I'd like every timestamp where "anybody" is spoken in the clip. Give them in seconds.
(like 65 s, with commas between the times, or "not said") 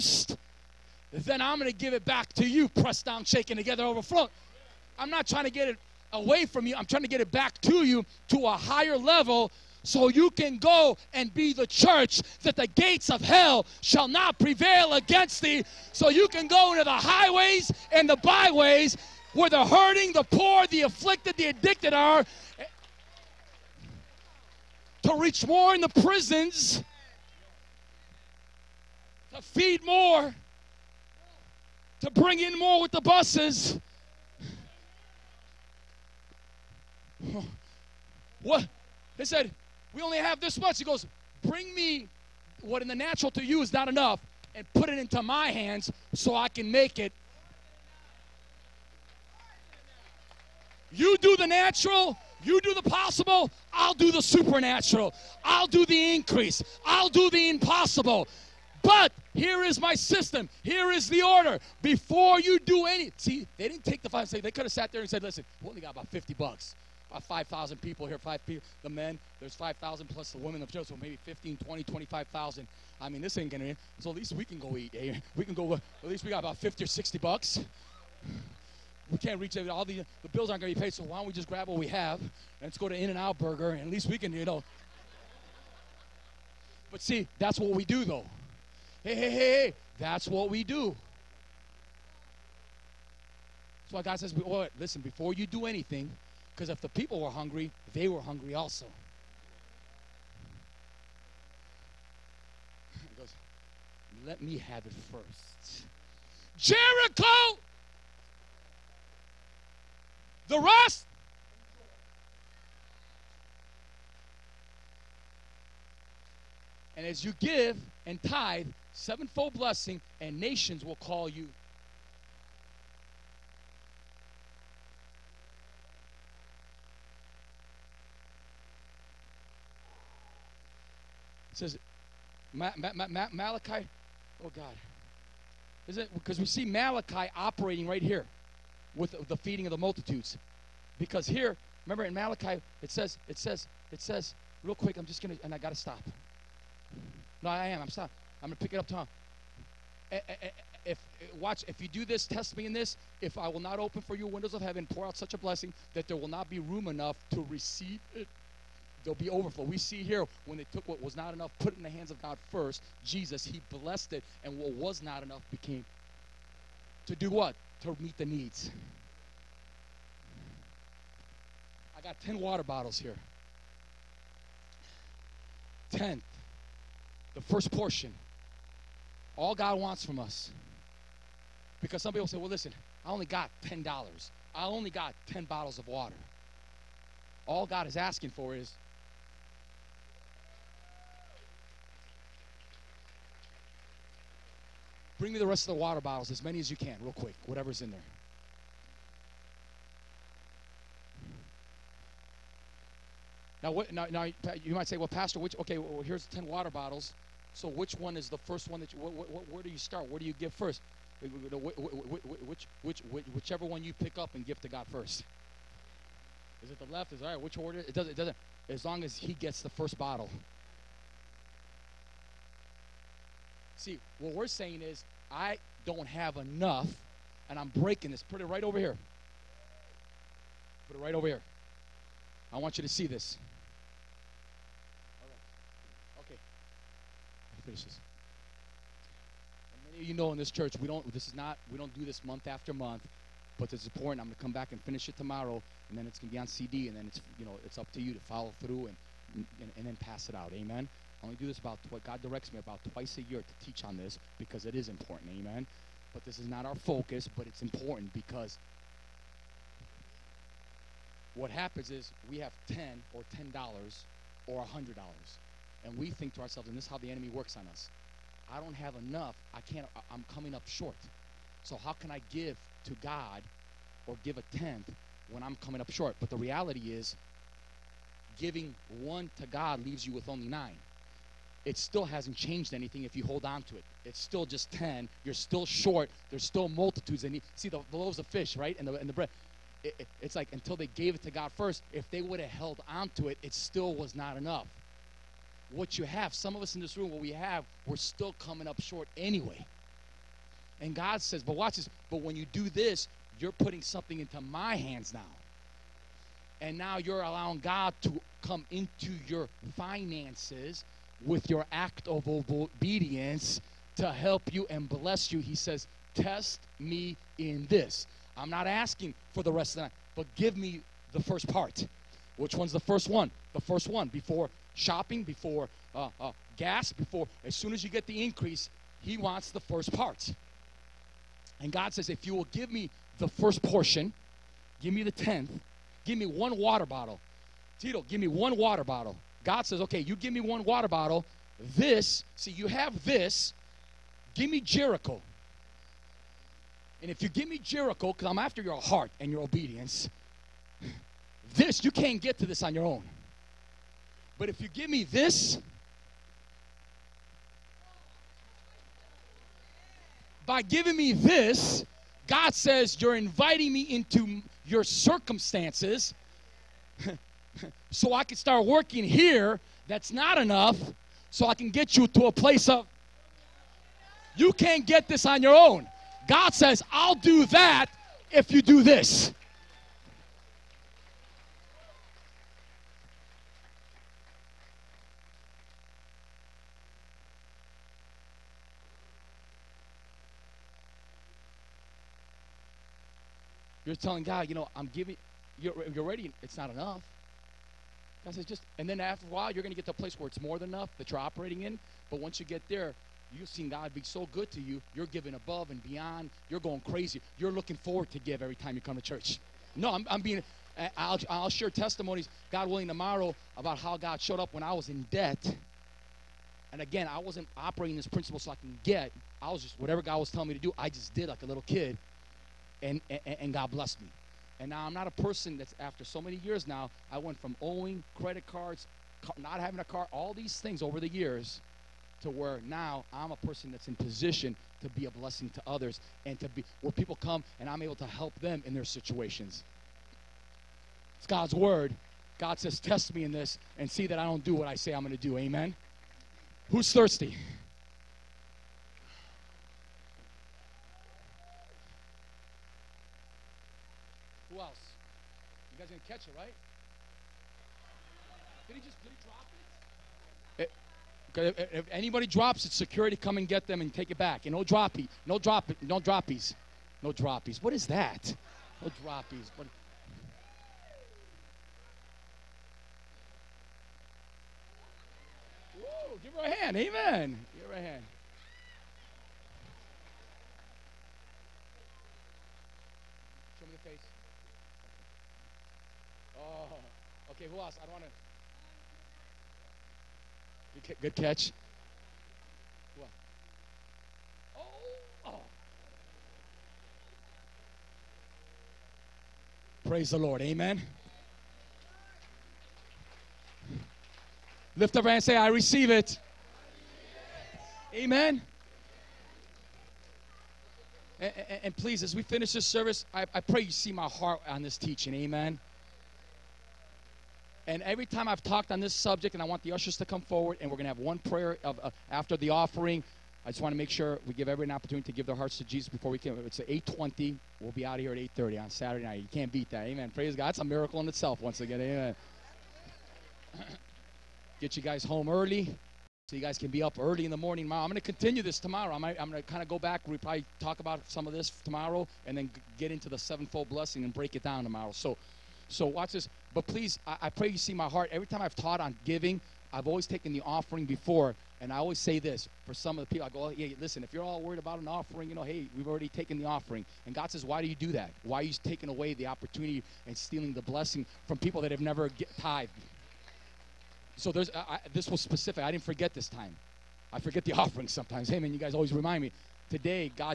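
461 s.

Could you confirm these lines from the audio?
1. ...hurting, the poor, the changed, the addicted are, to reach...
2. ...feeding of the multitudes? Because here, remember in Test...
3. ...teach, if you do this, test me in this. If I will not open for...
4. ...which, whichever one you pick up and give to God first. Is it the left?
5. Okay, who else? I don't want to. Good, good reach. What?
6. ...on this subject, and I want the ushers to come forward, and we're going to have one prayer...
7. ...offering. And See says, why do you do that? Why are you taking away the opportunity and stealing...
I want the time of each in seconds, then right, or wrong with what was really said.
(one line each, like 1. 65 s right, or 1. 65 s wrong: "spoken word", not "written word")
1. 19 s wrong: "afflicted", not "changed"
2. 139 s wrong: "Malachi", not "Test"
3. 151 s wrong: "watch", not "teach"
4. 213 s right
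5. 487 s wrong: "catch", not "reach"
6. 518 s right
7. 556 s wrong: "God", not "See".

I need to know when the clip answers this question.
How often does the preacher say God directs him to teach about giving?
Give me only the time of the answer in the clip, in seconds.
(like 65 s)
252 s.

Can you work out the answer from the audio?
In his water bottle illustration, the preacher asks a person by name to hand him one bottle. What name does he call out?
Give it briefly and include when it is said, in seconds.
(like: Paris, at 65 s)
Tito, at 337 s.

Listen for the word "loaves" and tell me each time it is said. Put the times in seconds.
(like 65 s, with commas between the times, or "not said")
287 s.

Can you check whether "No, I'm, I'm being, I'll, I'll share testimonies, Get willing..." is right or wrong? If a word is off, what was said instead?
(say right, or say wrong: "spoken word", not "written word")
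wrong: "God", not "Get".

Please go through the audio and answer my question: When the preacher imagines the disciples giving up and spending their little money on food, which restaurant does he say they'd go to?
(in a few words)
In N Out Burger.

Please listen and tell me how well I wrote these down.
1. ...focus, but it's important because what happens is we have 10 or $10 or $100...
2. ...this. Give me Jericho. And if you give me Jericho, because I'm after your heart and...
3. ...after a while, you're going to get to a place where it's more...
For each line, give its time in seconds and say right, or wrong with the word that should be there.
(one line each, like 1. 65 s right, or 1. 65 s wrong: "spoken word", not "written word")
1. 256 s right
2. 343 s right
3. 398 s right.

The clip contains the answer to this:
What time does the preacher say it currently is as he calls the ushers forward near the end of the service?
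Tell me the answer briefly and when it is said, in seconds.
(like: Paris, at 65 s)
8:20, at 526 s.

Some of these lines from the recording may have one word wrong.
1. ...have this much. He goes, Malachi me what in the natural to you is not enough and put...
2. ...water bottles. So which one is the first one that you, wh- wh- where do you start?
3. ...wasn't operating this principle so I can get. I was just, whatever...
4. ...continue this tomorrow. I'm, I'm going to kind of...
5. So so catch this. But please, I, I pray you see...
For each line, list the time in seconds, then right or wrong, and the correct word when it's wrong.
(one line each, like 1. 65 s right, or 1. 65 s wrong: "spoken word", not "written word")
1. 40 s wrong: "Bring", not "Malachi"
2. 206 s right
3. 417 s right
4. 537 s right
5. 544 s wrong: "watch", not "catch".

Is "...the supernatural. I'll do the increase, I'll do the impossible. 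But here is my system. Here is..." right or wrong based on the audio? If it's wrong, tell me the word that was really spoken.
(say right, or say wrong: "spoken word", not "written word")
right.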